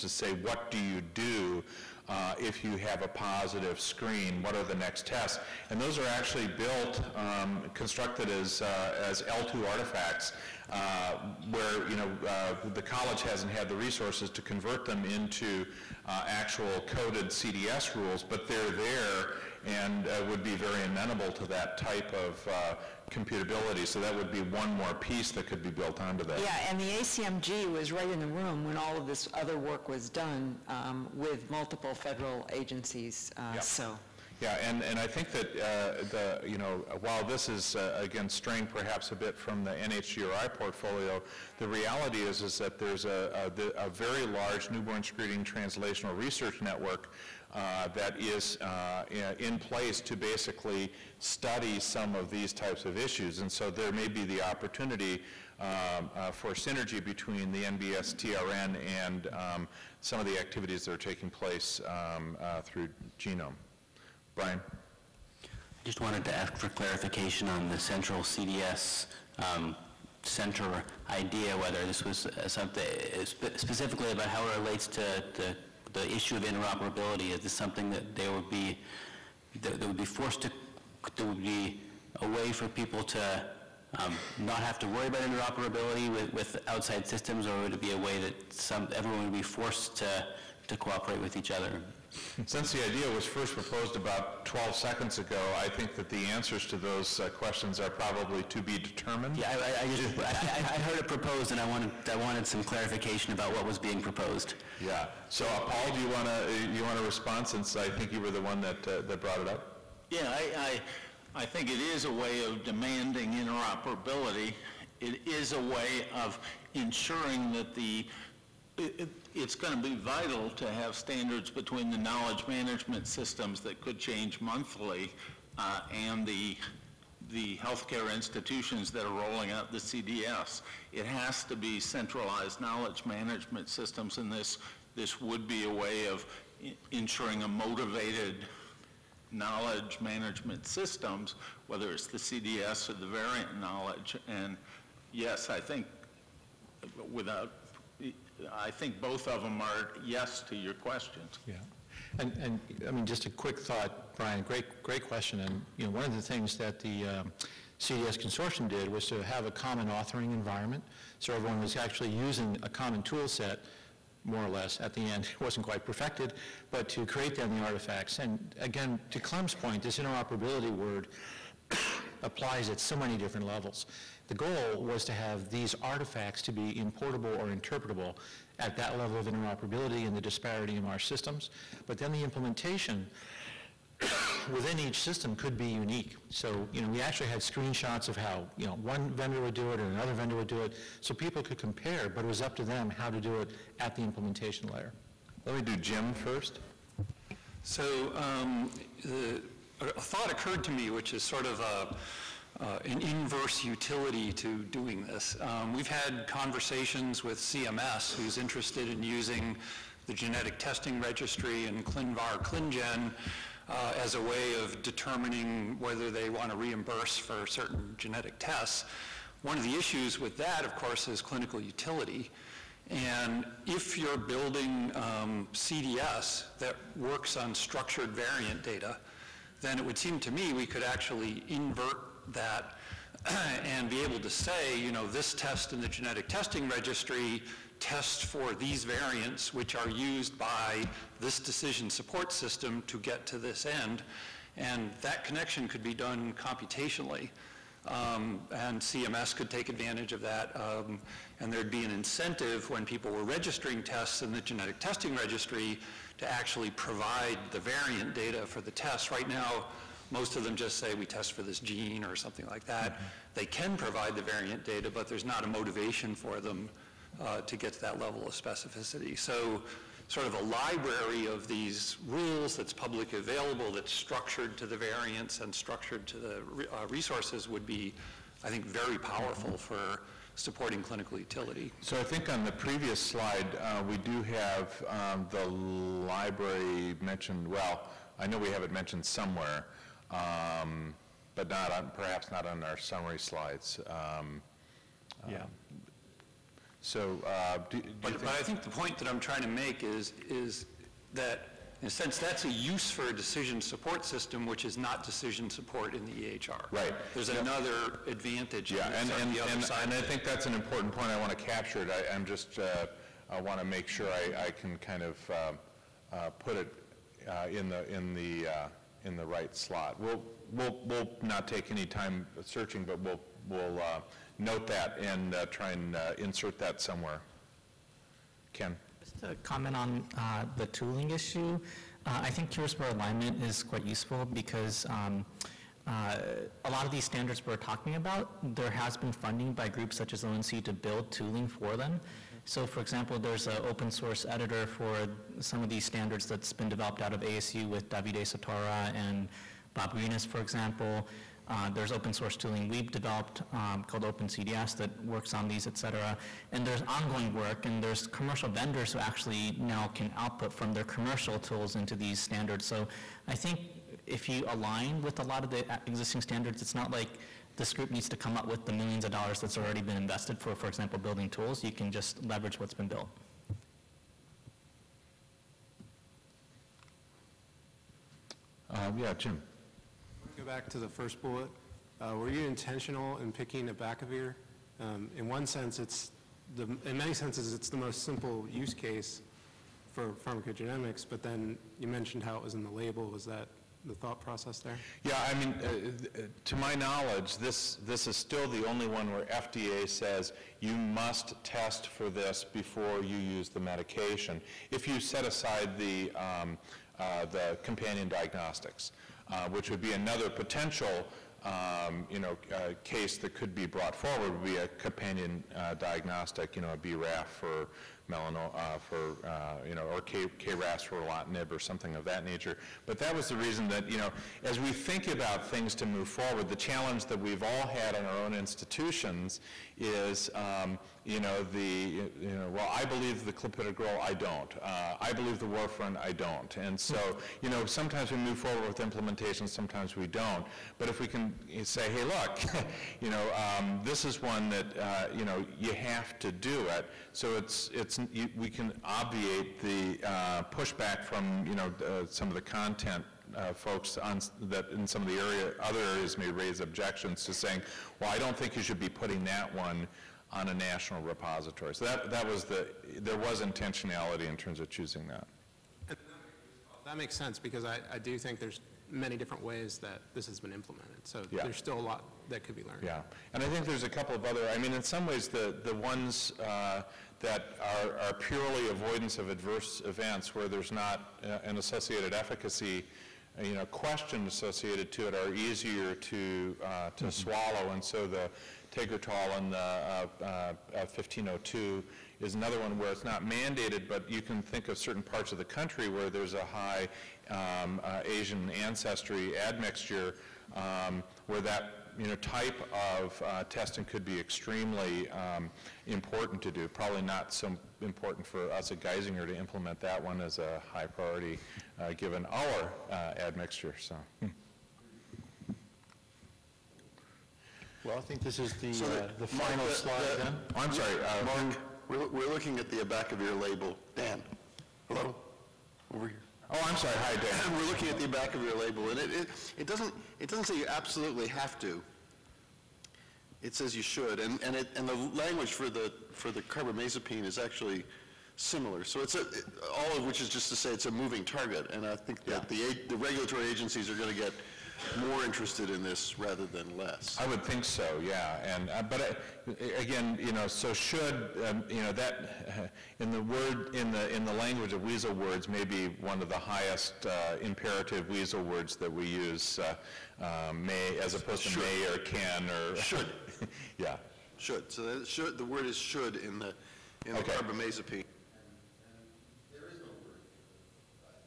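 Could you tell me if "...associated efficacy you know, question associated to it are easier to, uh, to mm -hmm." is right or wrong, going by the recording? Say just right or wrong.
right.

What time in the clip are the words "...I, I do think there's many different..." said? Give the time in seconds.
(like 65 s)
467 s.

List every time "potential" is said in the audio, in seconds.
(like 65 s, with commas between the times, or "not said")
410 s.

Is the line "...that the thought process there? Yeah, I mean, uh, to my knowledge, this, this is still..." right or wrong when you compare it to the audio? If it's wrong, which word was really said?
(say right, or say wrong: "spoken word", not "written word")
right.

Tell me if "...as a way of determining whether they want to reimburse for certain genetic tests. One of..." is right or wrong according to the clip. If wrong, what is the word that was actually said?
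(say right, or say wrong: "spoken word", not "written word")
right.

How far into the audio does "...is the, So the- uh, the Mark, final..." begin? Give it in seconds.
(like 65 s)
518 s.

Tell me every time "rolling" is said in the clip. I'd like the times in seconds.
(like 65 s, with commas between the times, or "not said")
129 s.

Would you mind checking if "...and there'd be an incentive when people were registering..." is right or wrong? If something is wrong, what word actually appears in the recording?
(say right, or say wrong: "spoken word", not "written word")
right.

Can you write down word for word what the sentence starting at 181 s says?
But then the implementation within each system could be unique.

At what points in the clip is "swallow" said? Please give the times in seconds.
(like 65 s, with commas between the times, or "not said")
487 s.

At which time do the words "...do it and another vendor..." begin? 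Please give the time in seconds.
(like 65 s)
189 s.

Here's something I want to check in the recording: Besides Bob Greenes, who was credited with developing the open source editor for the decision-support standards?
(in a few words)
Davide Sottara.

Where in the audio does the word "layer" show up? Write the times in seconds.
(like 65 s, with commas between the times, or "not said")
194 s.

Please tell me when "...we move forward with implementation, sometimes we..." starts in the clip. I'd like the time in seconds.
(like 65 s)
438 s.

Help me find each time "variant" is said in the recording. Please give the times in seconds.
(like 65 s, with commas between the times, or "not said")
143 s, 228 s, 238 s, 257 s, 264 s, 274 s.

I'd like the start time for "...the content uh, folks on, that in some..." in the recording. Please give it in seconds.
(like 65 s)
452 s.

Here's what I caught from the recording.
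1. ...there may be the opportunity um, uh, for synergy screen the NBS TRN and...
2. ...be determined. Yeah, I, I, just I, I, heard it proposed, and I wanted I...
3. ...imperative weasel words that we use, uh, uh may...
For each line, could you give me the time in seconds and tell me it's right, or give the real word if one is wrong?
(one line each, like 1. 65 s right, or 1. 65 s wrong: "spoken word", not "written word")
1. 53 s wrong: "between", not "screen"
2. 98 s right
3. 557 s right.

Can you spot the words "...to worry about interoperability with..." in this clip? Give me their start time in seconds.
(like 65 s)
84 s.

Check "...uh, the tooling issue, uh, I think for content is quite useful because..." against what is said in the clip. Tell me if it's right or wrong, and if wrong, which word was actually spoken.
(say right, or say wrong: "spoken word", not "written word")
wrong: "alignment", not "content".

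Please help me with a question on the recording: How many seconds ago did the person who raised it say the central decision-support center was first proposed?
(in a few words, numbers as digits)
12.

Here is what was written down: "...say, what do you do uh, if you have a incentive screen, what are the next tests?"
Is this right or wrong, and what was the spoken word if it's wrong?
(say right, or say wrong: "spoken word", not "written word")
wrong: "positive", not "incentive".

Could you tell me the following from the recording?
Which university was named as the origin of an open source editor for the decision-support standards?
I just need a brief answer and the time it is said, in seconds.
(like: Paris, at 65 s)
ASU, at 347 s.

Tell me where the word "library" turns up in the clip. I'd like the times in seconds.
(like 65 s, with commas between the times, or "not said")
270 s, 285 s.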